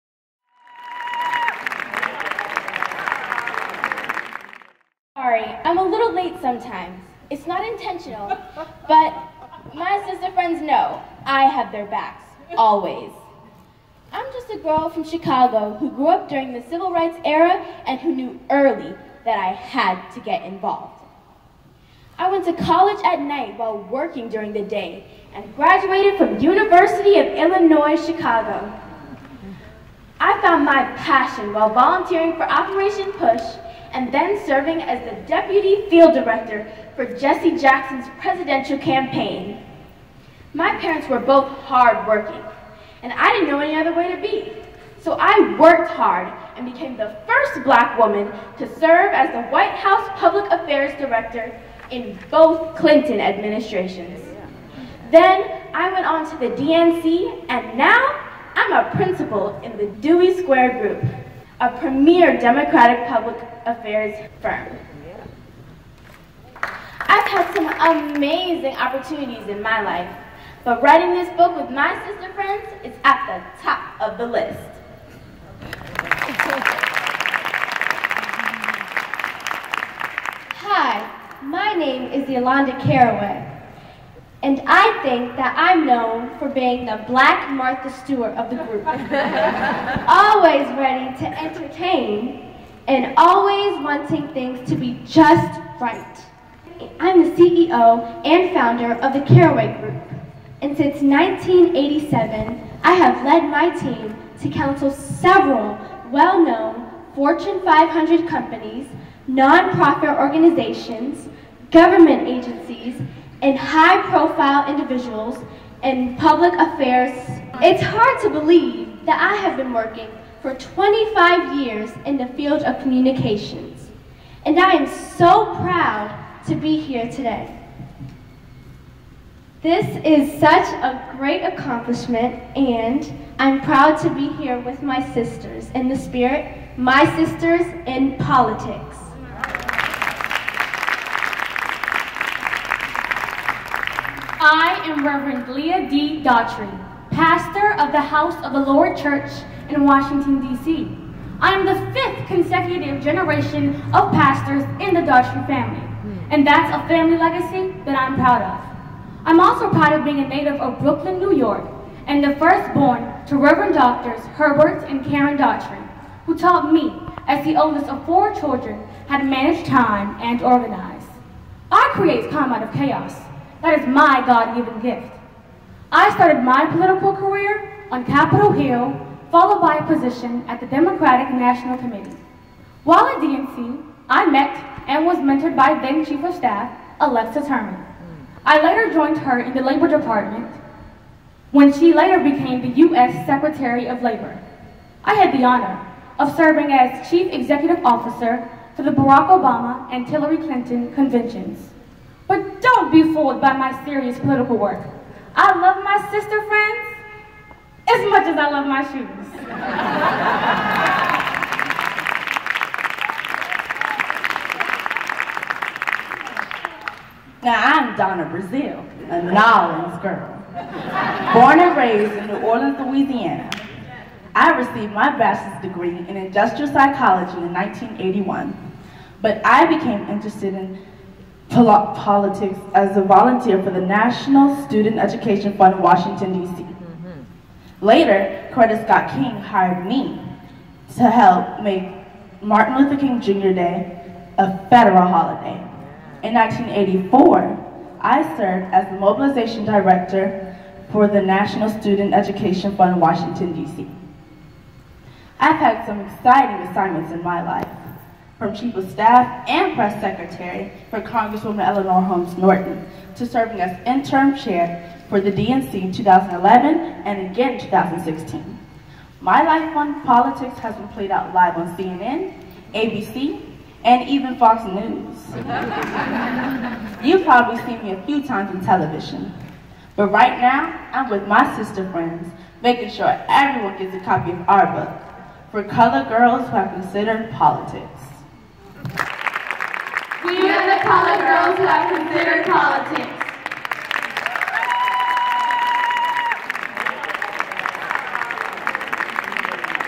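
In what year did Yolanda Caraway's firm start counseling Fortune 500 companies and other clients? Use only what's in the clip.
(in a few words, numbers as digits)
1987.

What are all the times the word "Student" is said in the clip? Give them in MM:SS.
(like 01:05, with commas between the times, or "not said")
03:54, 04:11.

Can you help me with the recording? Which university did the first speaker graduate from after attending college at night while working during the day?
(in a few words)
University of Illinois, Chicago.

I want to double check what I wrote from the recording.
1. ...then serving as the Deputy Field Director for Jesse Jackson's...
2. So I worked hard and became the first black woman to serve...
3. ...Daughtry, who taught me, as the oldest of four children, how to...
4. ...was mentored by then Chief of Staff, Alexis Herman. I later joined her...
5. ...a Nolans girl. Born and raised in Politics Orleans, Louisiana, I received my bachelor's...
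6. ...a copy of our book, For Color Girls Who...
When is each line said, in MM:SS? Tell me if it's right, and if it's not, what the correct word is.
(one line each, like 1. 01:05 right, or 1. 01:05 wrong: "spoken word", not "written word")
1. 00:34 right
2. 00:45 right
3. 02:45 right
4. 03:05 right
5. 03:39 wrong: "New", not "Politics"
6. 04:43 right.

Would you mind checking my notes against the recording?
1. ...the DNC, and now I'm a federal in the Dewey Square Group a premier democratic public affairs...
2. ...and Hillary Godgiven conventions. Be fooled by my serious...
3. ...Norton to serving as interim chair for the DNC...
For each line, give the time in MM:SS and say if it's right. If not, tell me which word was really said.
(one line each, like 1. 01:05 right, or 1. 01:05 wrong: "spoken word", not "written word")
1. 00:56 wrong: "principal", not "federal"
2. 03:19 wrong: "Clinton", not "Godgiven"
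3. 04:22 right.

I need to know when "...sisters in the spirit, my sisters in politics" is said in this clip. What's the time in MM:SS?
02:15.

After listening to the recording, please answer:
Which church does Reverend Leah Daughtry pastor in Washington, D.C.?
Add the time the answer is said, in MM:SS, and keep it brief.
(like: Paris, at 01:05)
House of the Lord Church, at 02:28.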